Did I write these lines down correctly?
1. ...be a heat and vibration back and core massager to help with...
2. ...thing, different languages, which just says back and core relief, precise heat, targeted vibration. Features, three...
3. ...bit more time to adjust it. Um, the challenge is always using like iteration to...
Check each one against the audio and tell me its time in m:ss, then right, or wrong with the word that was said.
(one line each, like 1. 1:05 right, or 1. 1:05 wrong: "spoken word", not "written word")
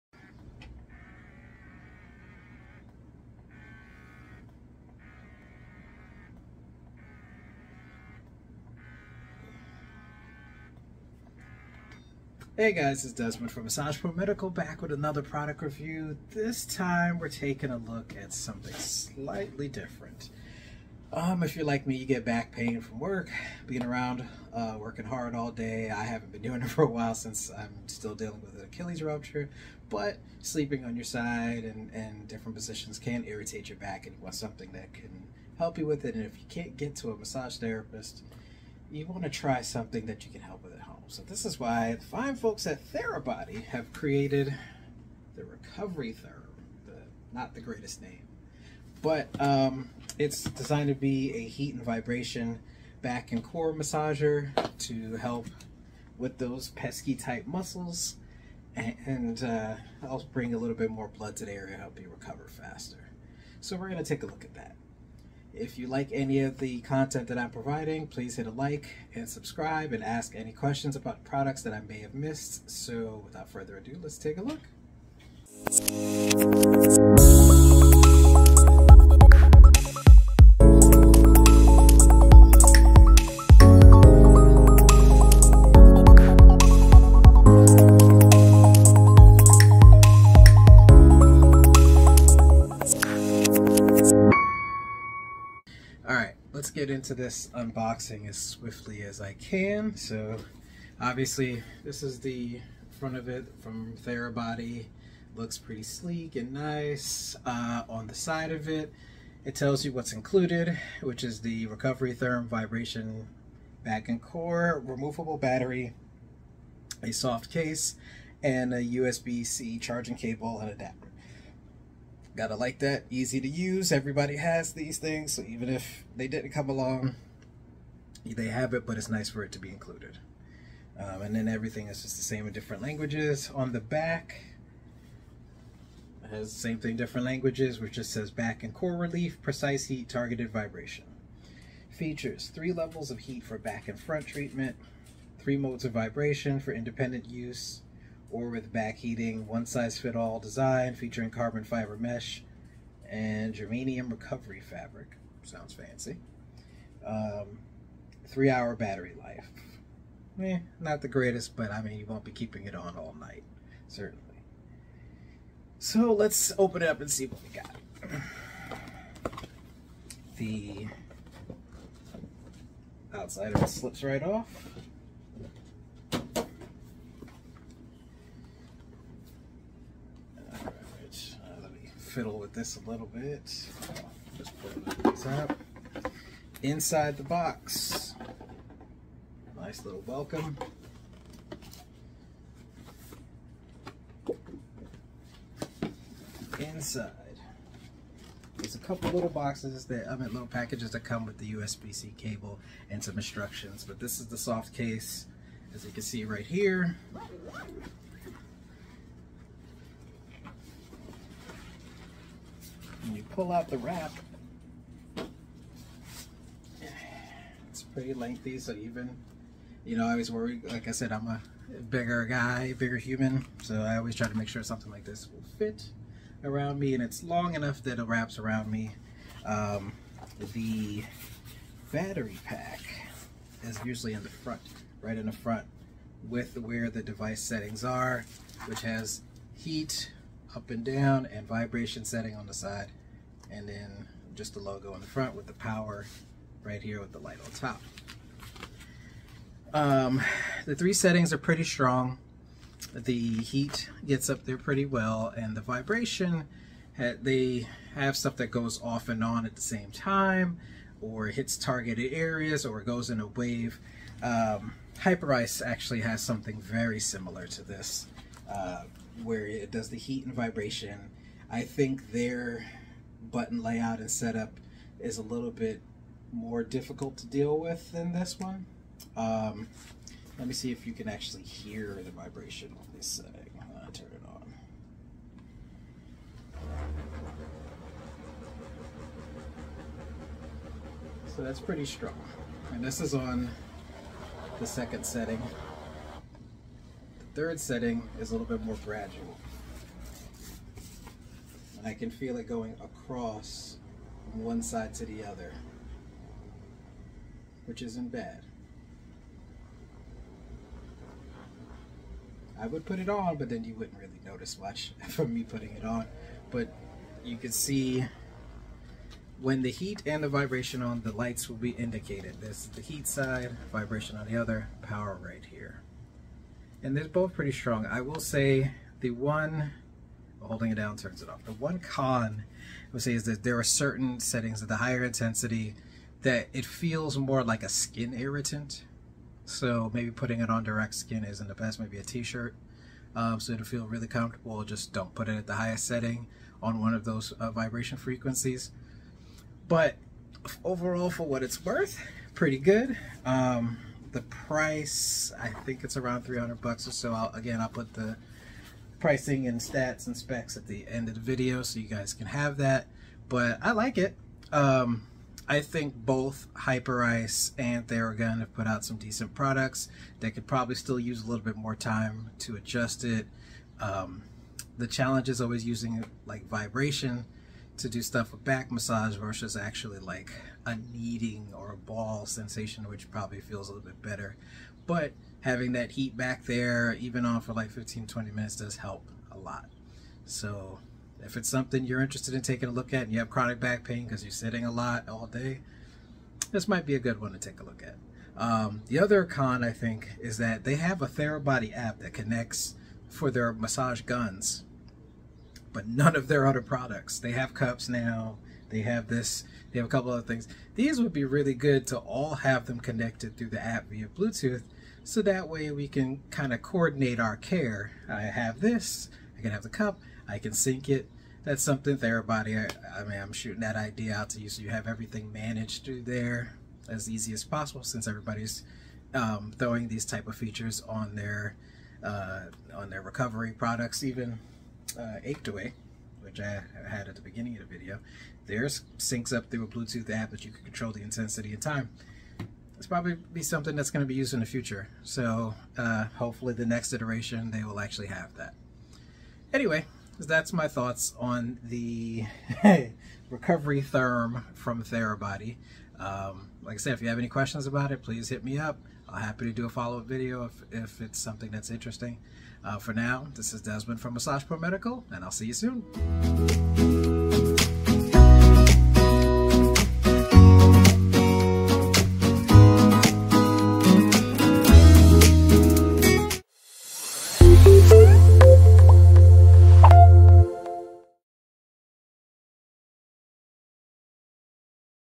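1. 0:50 right
2. 2:16 right
3. 6:11 wrong: "vibration", not "iteration".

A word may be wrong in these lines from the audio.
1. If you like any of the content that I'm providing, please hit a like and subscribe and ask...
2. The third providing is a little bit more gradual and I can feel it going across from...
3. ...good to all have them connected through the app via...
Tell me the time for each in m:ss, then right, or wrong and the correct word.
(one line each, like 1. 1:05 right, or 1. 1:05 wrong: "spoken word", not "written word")
1. 1:05 right
2. 4:57 wrong: "setting", not "providing"
3. 6:51 right.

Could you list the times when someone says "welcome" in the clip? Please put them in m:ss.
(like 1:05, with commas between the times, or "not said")
3:10.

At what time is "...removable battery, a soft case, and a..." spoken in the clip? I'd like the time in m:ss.
1:54.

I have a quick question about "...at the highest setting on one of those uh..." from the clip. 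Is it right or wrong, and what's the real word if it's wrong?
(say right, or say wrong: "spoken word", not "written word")
right.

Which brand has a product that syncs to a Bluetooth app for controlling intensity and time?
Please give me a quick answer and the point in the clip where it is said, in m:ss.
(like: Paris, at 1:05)
Achedaway, at 7:15.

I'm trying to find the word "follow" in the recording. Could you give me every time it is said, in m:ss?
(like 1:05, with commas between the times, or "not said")
7:39.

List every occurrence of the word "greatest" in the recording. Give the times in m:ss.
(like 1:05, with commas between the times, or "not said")
0:47, 2:41.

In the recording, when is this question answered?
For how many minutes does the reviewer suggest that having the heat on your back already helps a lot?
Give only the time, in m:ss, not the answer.
6:27.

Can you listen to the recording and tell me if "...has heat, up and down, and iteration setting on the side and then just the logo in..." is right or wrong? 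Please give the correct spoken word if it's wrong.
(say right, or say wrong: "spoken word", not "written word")
wrong: "vibration", not "iteration".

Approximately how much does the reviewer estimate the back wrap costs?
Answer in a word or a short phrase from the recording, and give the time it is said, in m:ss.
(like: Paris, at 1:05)
$300, at 5:56.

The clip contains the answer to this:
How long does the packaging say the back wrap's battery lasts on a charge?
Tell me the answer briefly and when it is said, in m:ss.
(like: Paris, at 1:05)
3 hours, at 2:38.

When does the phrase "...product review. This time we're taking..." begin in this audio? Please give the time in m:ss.
0:15.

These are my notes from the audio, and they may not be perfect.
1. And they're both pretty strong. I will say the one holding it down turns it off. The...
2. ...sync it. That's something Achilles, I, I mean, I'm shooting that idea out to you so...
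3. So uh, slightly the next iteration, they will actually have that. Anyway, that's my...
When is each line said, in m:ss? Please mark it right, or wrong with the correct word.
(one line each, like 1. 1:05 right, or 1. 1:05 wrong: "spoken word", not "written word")
1. 5:26 right
2. 7:00 wrong: "Therabody", not "Achilles"
3. 7:25 wrong: "hopefully", not "slightly".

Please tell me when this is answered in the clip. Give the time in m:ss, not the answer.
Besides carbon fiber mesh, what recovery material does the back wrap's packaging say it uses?
2:33.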